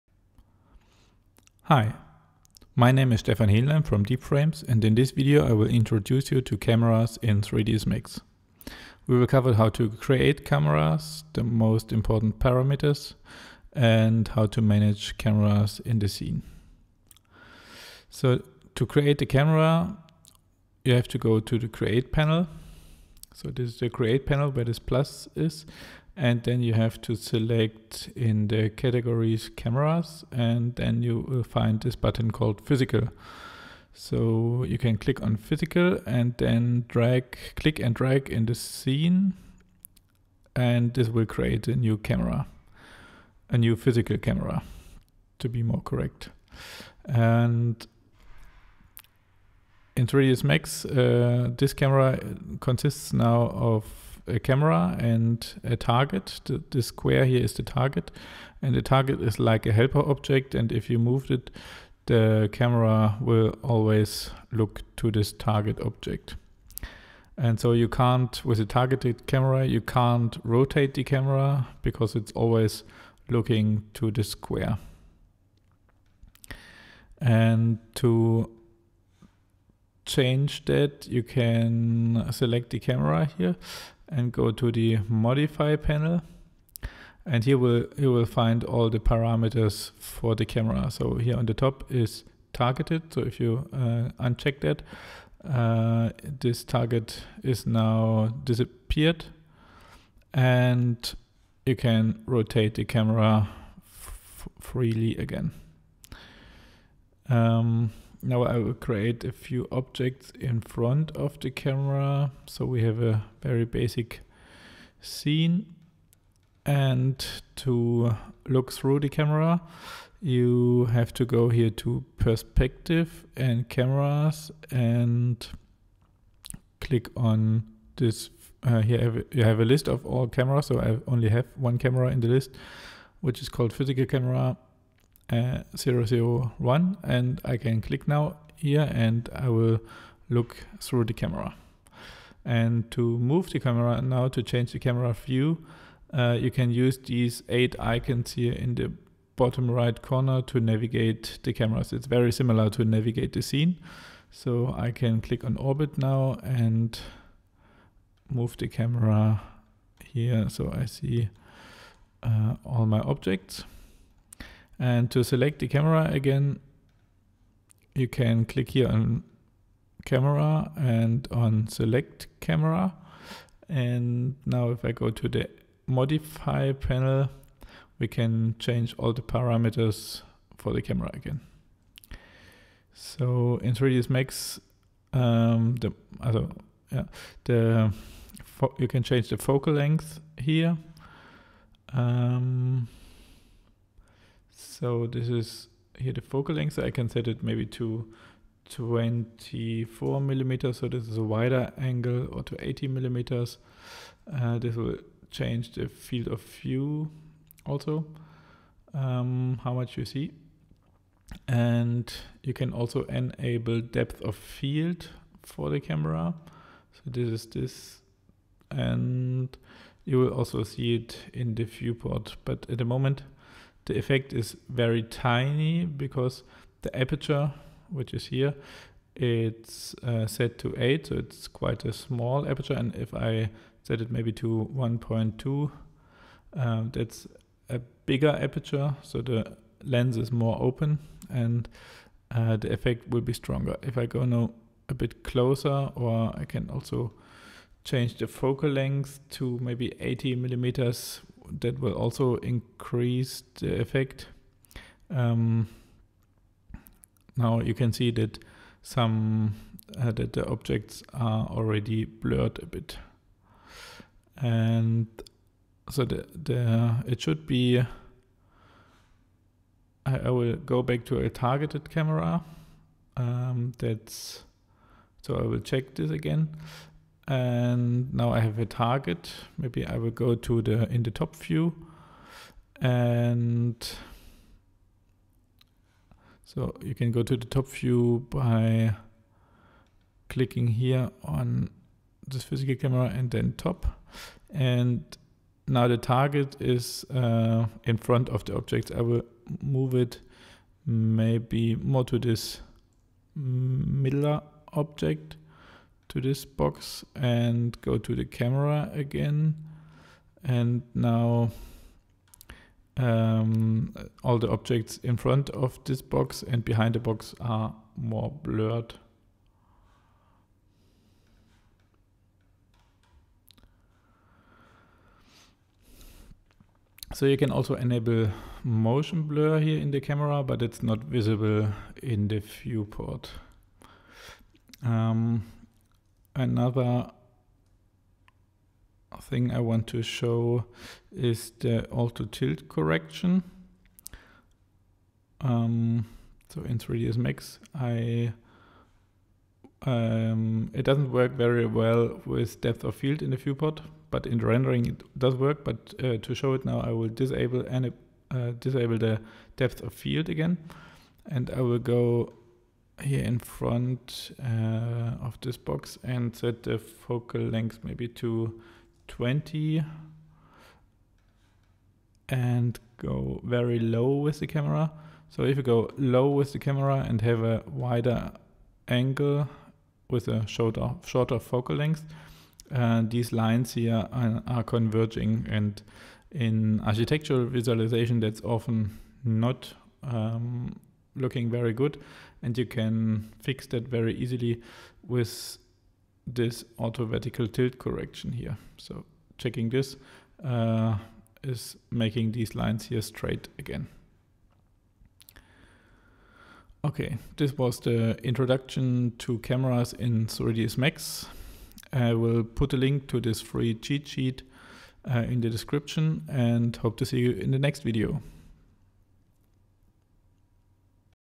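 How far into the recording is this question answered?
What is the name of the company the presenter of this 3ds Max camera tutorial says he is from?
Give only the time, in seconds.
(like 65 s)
4 s.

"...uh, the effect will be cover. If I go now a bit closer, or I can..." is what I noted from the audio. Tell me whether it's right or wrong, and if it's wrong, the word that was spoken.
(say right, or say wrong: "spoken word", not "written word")
wrong: "stronger", not "cover".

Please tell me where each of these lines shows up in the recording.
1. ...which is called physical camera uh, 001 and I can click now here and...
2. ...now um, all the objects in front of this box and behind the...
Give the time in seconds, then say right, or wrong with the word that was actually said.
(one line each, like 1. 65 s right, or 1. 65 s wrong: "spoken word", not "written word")
1. 133 s right
2. 310 s right.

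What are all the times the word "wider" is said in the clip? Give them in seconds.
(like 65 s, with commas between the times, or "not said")
201 s, 377 s.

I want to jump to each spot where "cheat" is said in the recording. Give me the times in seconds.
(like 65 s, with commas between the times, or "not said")
413 s.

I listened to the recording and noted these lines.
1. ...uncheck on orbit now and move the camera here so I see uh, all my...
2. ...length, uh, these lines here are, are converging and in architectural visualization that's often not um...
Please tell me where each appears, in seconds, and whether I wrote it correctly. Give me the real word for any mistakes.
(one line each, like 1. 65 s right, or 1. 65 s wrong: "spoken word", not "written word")
1. 155 s wrong: "click", not "uncheck"
2. 381 s right.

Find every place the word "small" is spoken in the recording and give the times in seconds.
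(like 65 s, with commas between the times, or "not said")
231 s.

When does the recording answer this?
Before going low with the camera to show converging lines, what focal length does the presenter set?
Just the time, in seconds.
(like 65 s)
369 s.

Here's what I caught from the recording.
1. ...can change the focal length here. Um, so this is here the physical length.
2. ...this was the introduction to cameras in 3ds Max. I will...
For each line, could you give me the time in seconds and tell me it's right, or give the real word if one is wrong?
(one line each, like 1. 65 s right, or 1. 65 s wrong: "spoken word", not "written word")
1. 188 s wrong: "focal", not "physical"
2. 407 s right.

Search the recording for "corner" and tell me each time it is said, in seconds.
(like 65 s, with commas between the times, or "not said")
150 s.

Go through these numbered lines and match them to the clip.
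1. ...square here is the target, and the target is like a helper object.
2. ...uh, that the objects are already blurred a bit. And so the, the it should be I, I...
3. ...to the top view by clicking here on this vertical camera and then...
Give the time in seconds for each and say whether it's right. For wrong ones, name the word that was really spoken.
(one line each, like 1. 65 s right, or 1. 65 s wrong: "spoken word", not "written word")
1. 56 s right
2. 259 s right
3. 287 s wrong: "physical", not "vertical".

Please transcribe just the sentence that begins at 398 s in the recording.
So checking this uh, is making these lines here straight again.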